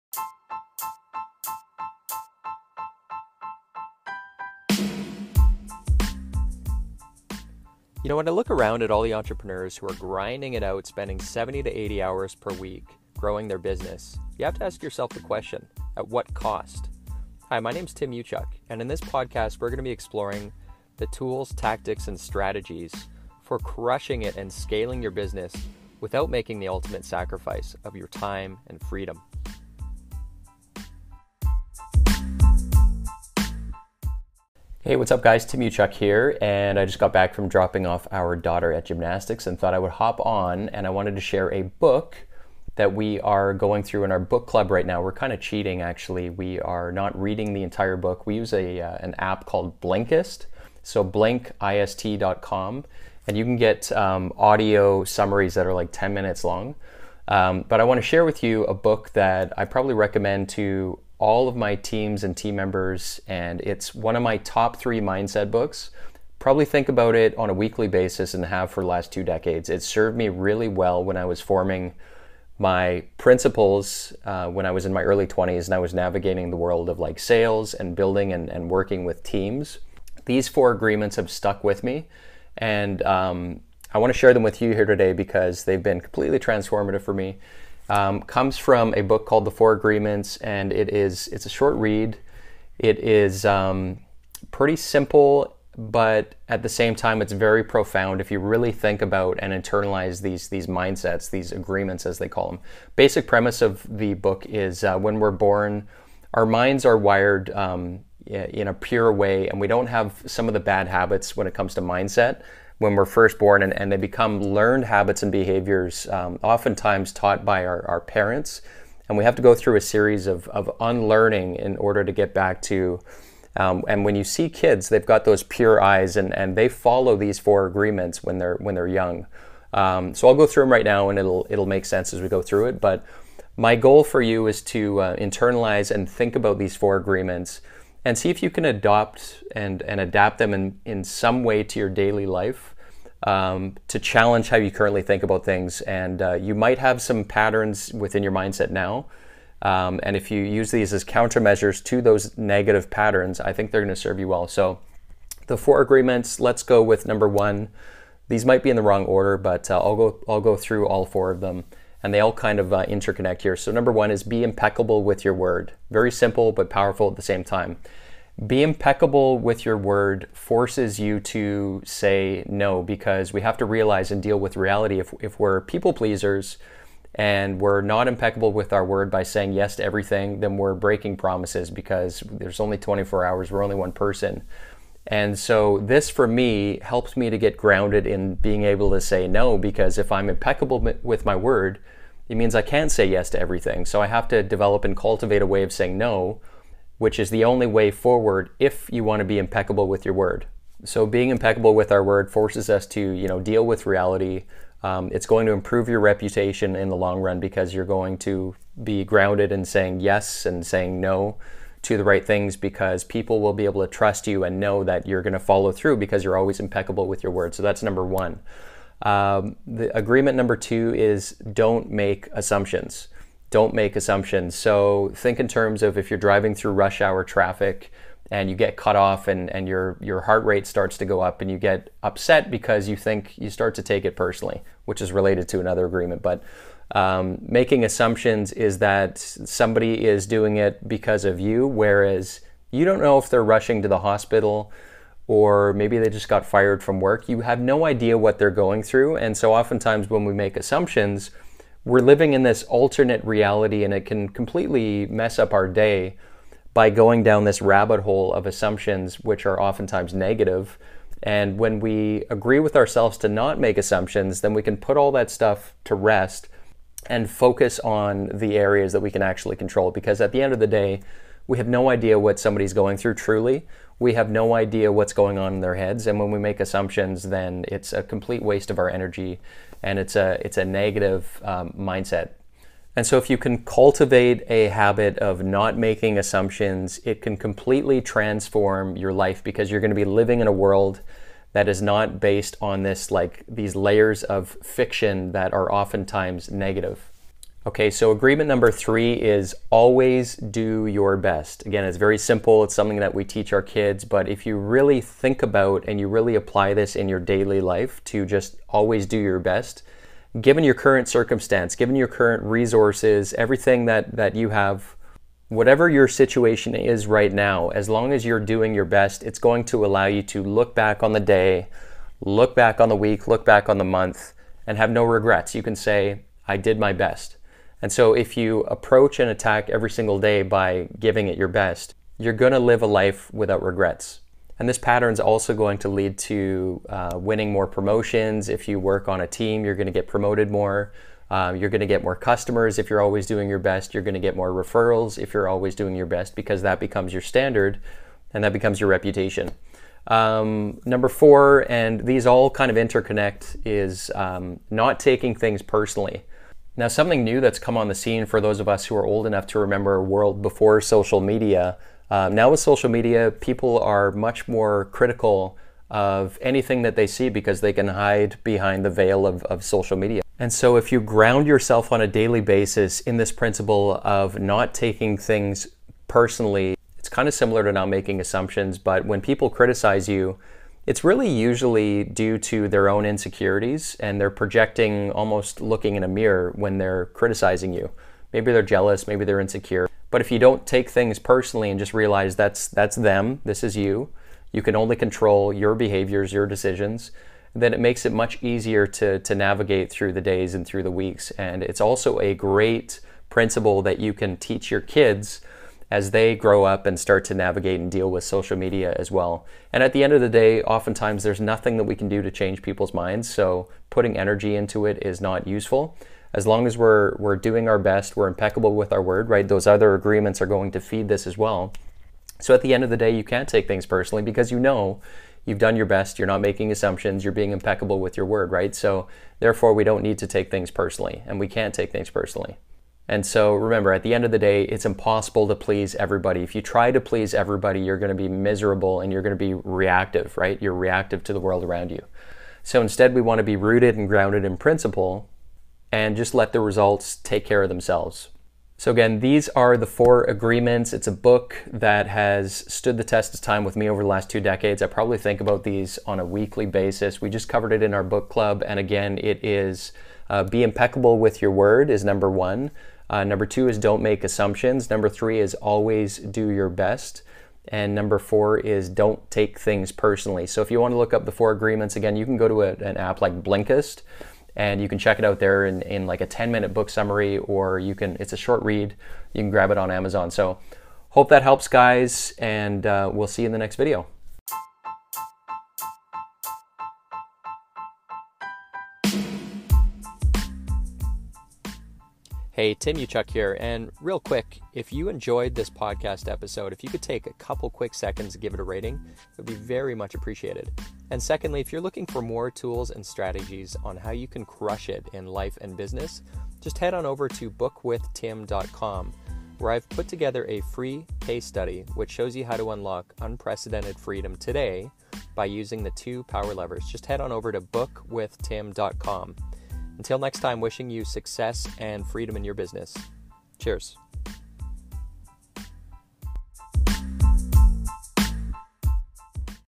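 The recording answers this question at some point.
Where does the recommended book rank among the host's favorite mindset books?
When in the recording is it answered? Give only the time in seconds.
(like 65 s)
64 s.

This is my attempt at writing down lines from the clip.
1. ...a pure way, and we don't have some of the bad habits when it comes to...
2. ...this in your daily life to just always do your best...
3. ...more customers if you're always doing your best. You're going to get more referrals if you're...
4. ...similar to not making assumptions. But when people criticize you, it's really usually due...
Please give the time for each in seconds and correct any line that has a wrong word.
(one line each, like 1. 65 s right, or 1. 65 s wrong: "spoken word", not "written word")
1. 108 s right
2. 306 s right
3. 342 s right
4. 377 s right.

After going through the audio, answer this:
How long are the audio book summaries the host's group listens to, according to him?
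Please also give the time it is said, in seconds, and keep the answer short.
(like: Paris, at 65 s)
10 minutes, at 55 s.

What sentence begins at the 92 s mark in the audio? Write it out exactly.
It is um, pretty simple, but at the same time, it's very profound.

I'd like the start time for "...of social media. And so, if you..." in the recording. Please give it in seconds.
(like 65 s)
369 s.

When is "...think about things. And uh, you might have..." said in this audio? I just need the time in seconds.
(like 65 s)
145 s.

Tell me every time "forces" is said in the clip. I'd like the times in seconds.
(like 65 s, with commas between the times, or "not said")
170 s, 202 s.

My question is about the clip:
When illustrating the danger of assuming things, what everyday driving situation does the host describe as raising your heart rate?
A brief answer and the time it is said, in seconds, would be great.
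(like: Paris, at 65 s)
rush hour traffic, at 226 s.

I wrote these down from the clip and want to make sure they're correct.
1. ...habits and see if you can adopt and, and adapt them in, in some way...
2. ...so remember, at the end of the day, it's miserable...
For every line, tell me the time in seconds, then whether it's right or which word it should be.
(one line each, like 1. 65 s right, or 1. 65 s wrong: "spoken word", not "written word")
1. 136 s wrong: "agreements", not "habits"
2. 433 s wrong: "impossible", not "miserable".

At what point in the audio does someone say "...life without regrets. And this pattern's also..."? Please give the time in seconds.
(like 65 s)
332 s.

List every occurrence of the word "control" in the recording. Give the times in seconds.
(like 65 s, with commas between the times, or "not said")
269 s, 394 s.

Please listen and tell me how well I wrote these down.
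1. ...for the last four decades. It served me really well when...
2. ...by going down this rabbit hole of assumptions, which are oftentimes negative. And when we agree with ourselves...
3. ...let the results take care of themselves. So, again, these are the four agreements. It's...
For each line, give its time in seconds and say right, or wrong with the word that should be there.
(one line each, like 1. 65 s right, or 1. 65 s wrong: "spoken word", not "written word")
1. 68 s wrong: "two", not "four"
2. 256 s right
3. 446 s right.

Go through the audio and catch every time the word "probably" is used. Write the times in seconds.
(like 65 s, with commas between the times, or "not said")
59 s, 66 s, 454 s.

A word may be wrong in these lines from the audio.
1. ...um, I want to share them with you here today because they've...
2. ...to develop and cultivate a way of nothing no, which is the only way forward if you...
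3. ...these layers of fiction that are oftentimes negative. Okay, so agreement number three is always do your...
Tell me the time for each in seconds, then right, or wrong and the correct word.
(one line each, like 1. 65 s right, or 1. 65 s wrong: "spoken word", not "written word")
1. 83 s right
2. 194 s wrong: "saying", not "nothing"
3. 293 s right.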